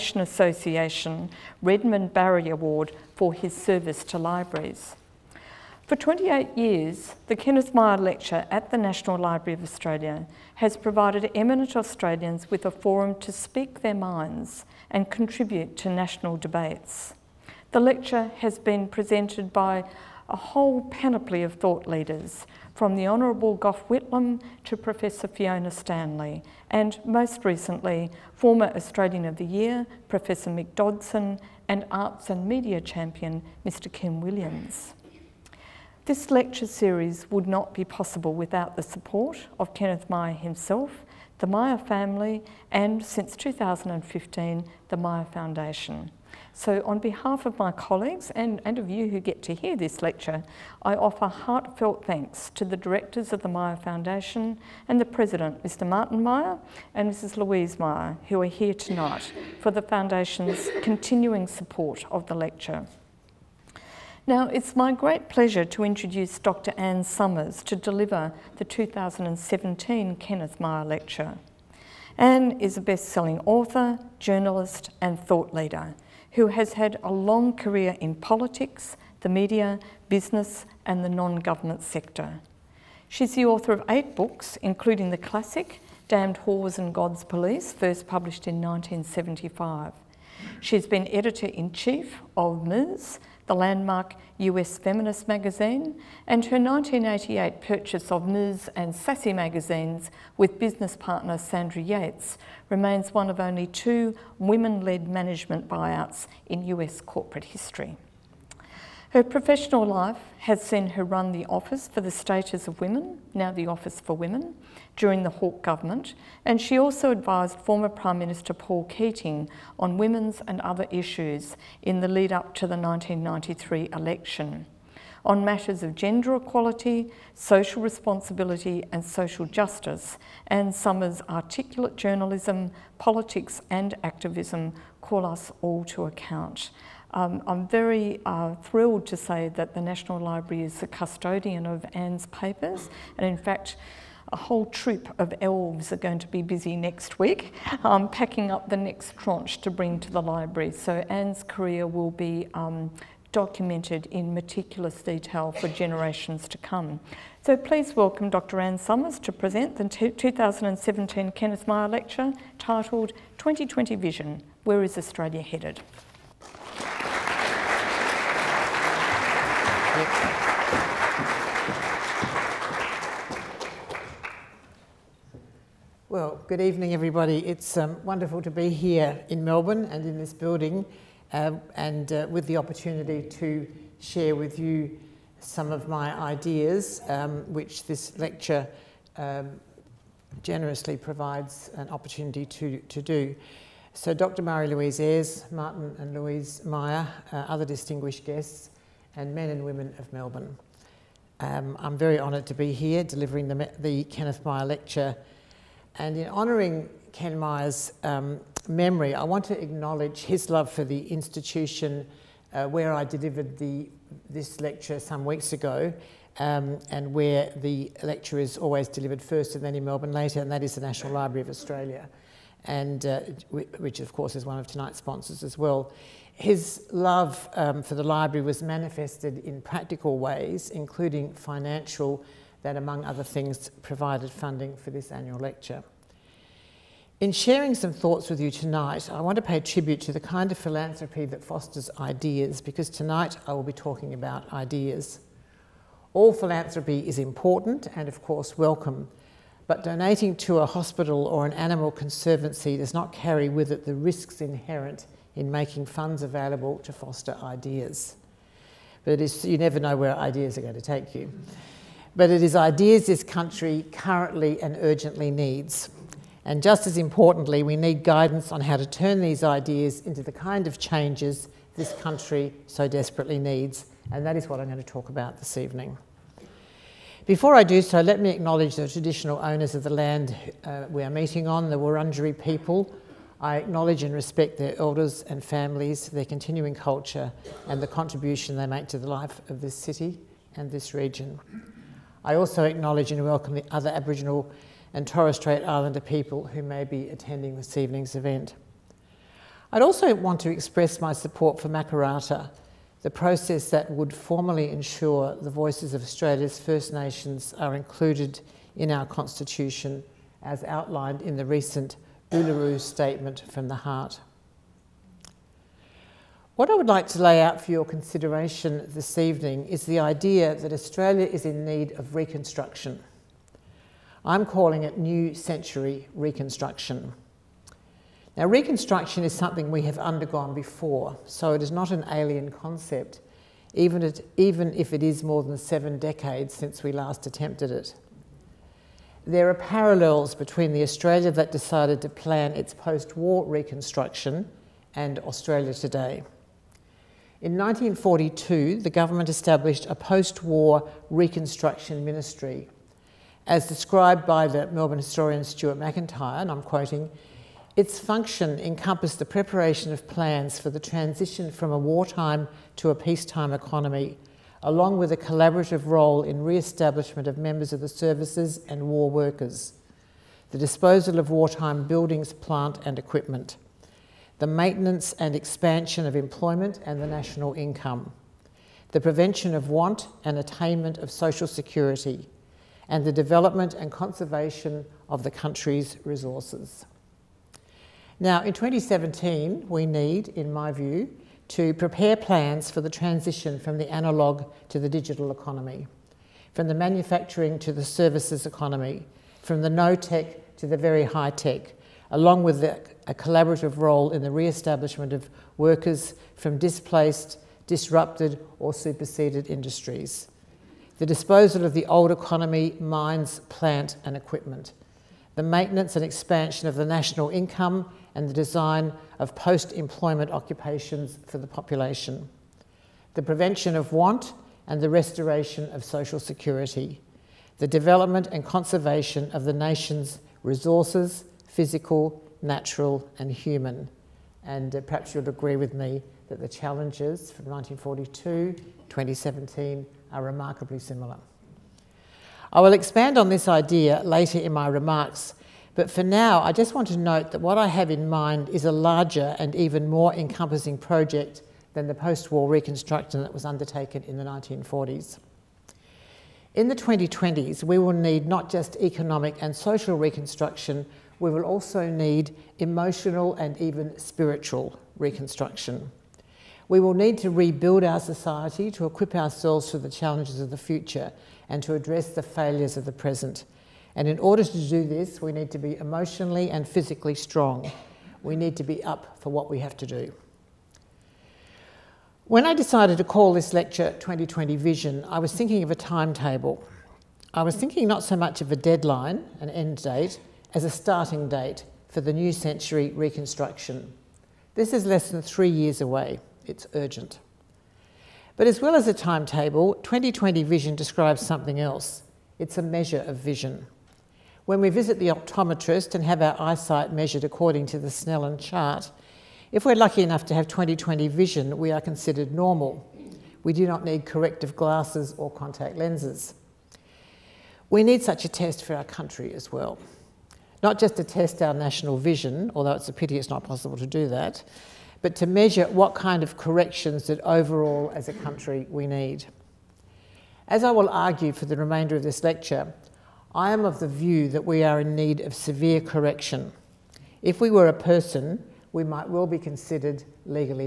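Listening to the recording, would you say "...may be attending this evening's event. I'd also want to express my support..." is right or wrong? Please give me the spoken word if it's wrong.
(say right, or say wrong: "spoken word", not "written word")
right.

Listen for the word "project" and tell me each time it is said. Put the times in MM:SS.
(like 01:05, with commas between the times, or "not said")
07:30.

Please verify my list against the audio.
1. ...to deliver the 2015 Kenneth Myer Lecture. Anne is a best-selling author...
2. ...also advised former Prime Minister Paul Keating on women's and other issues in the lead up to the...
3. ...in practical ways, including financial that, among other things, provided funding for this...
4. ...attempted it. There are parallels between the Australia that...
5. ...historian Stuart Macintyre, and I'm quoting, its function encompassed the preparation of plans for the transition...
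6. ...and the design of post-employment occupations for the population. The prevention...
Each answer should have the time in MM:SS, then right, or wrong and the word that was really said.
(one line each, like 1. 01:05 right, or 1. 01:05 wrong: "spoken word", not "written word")
1. 01:07 wrong: "2017", not "2015"
2. 01:56 right
3. 03:49 right
4. 05:37 right
5. 05:54 right
6. 06:58 right.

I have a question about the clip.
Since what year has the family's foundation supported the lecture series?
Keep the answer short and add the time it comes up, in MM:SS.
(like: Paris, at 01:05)
2015, at 00:43.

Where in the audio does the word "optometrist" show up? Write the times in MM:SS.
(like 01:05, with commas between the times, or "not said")
08:25.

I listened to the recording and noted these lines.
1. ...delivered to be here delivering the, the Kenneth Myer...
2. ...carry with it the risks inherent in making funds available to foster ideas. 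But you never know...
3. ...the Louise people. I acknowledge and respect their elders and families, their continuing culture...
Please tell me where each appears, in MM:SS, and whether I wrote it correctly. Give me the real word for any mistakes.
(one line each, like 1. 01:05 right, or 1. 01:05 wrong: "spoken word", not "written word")
1. 03:22 wrong: "honoured", not "delivered"
2. 04:13 right
3. 04:41 wrong: "Wurundjeri", not "Louise".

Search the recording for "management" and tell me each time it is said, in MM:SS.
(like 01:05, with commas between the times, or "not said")
01:45.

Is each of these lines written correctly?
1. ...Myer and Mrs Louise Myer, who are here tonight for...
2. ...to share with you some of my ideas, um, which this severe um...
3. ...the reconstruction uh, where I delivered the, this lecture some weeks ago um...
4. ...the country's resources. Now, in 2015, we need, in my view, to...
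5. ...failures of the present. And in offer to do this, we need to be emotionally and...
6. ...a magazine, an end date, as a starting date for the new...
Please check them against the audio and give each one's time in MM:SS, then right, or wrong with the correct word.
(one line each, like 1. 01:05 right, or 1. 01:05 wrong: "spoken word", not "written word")
1. 00:56 right
2. 03:03 wrong: "lecture", not "severe"
3. 03:30 wrong: "institution", not "reconstruction"
4. 06:25 wrong: "2017", not "2015"
5. 07:52 wrong: "order", not "offer"
6. 08:08 wrong: "deadline", not "magazine".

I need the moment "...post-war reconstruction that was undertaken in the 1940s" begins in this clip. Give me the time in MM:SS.
07:31.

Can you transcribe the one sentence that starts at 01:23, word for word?
She's the author of eight books, including the classic Damned Whores and God's Police, first published in 1975.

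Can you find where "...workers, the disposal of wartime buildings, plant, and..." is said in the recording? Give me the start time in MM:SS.
06:09.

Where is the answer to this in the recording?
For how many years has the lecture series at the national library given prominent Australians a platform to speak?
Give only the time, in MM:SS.
00:05.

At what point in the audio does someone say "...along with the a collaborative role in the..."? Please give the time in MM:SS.
06:42.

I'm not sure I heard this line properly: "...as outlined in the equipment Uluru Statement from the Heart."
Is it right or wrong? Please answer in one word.
wrong.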